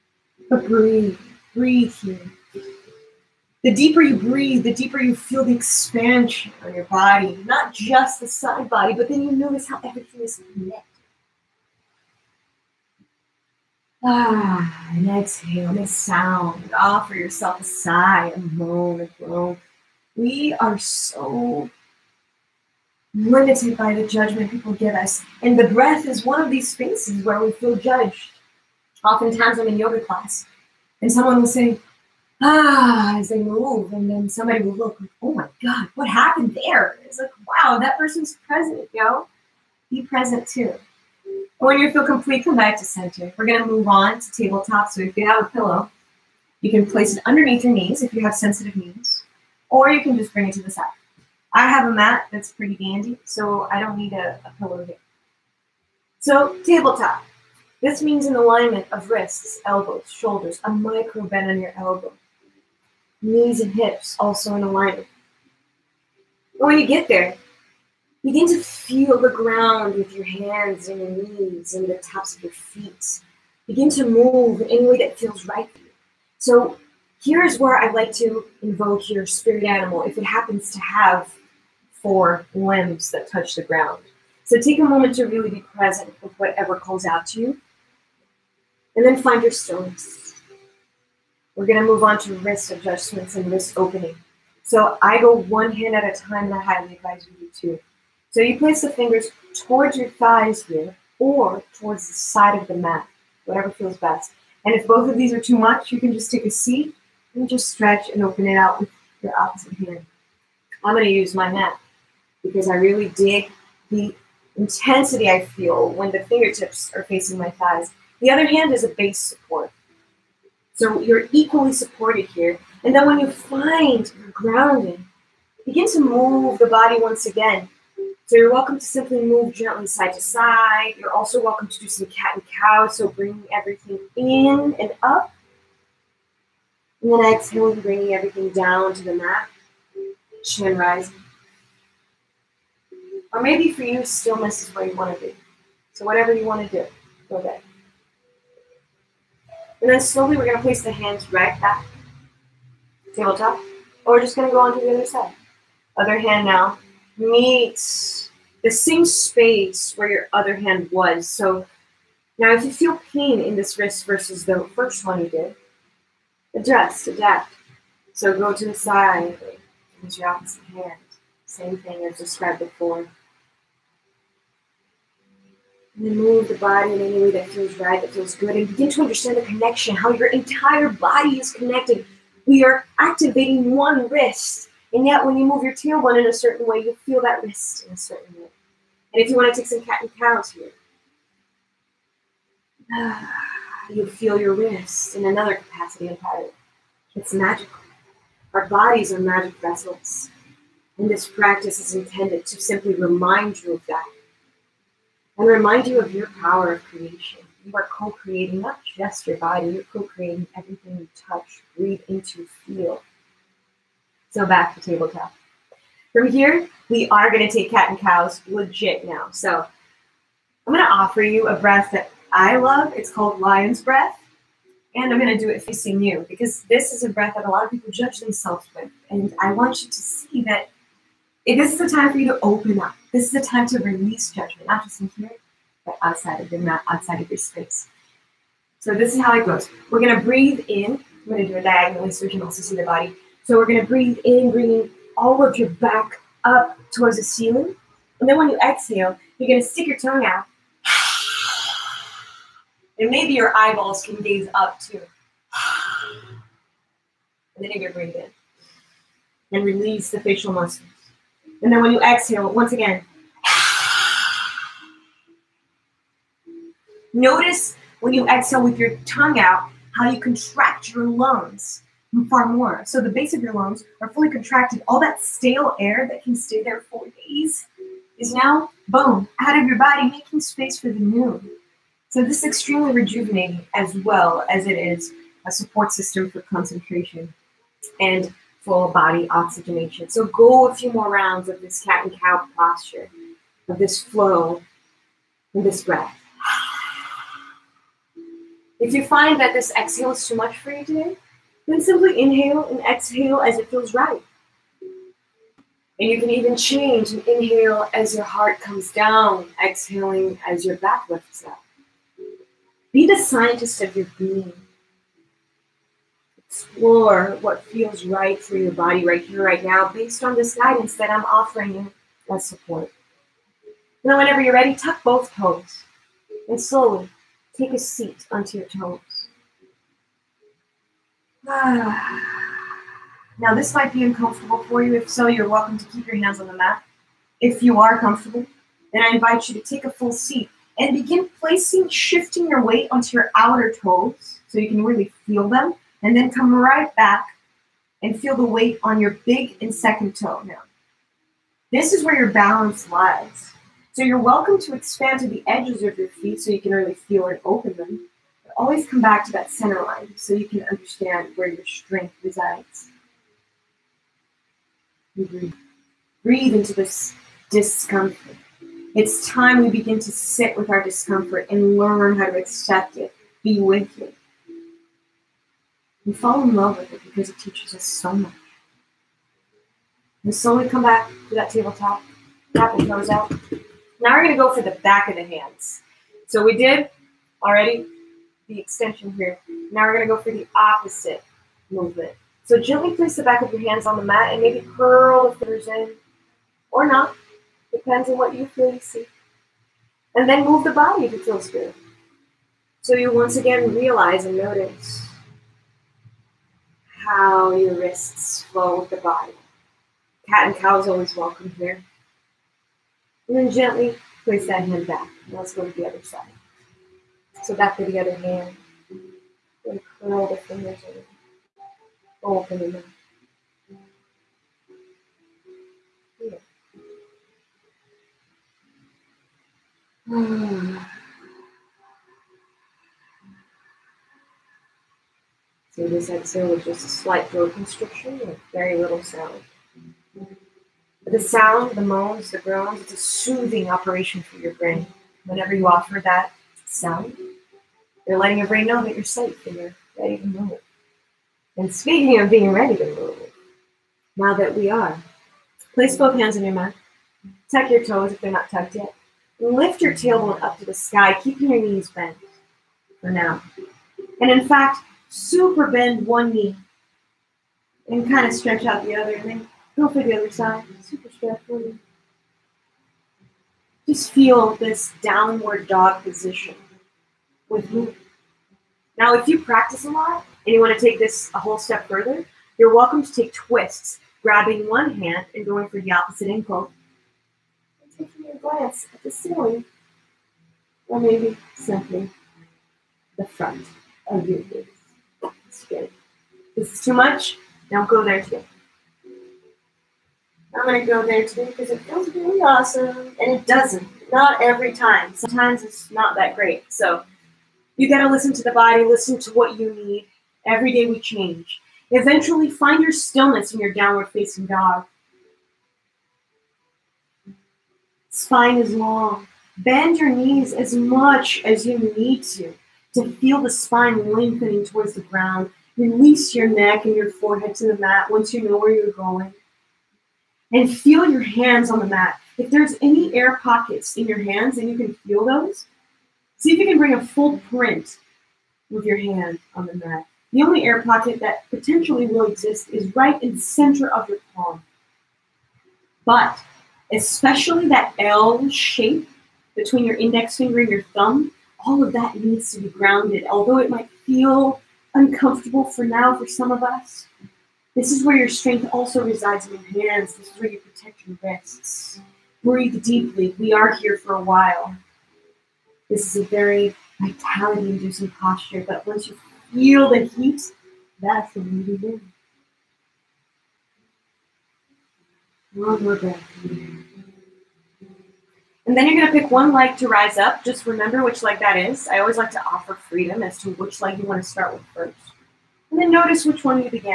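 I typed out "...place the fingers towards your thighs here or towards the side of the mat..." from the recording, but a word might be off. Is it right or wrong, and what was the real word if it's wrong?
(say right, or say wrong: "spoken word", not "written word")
right.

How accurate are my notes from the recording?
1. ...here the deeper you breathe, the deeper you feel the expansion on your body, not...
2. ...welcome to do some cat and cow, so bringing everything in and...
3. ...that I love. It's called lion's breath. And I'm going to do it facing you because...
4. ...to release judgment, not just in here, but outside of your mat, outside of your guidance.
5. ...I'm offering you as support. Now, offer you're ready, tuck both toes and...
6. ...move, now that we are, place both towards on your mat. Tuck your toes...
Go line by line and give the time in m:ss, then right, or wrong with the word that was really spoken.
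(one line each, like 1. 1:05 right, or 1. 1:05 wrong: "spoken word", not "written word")
1. 0:01 right
2. 2:11 right
3. 3:41 right
4. 3:53 wrong: "space", not "guidance"
5. 5:21 wrong: "whenever", not "offer"
6. 7:32 wrong: "hands", not "towards".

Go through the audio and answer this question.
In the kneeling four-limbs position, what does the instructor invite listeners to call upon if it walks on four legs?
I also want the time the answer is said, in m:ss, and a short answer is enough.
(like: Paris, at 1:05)
spirit animal, at 1:19.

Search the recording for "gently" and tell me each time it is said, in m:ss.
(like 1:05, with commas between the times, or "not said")
2:09, 6:32, 6:53.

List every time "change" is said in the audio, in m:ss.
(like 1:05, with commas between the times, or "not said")
5:06, 8:31.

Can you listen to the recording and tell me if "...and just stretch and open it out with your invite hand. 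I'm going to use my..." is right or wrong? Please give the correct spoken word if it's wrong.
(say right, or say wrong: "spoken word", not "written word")
wrong: "opposite", not "invite".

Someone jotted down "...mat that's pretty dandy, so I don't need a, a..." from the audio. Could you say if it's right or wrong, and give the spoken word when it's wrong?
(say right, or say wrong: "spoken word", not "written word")
right.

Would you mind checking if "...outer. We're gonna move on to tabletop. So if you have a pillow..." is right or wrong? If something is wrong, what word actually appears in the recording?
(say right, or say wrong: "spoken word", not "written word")
wrong: "center", not "outer".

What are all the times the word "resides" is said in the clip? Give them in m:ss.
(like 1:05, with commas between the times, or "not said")
6:02, 9:19.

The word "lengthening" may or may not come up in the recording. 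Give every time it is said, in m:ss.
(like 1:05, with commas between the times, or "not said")
8:44.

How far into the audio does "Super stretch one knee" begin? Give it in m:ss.
7:50.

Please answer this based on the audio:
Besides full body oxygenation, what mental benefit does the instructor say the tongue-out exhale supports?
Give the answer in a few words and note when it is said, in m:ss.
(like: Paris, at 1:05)
concentration, at 4:46.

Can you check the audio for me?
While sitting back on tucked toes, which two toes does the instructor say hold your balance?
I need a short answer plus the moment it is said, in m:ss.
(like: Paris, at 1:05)
big and second toe, at 5:49.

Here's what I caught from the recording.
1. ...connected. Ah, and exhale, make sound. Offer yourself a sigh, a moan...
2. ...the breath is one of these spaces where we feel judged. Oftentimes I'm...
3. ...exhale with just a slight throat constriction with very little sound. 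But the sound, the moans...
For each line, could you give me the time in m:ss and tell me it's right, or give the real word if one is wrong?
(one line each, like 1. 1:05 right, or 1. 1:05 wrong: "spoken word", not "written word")
1. 0:10 right
2. 0:25 right
3. 7:16 right.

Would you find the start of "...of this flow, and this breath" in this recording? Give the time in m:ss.
4:53.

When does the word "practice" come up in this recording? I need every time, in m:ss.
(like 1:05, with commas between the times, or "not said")
3:21, 7:59.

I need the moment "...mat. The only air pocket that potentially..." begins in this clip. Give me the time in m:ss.
8:59.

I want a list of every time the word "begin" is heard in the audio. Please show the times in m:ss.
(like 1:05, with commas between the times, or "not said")
1:08, 1:13, 2:05, 2:58, 5:40, 6:09, 9:31.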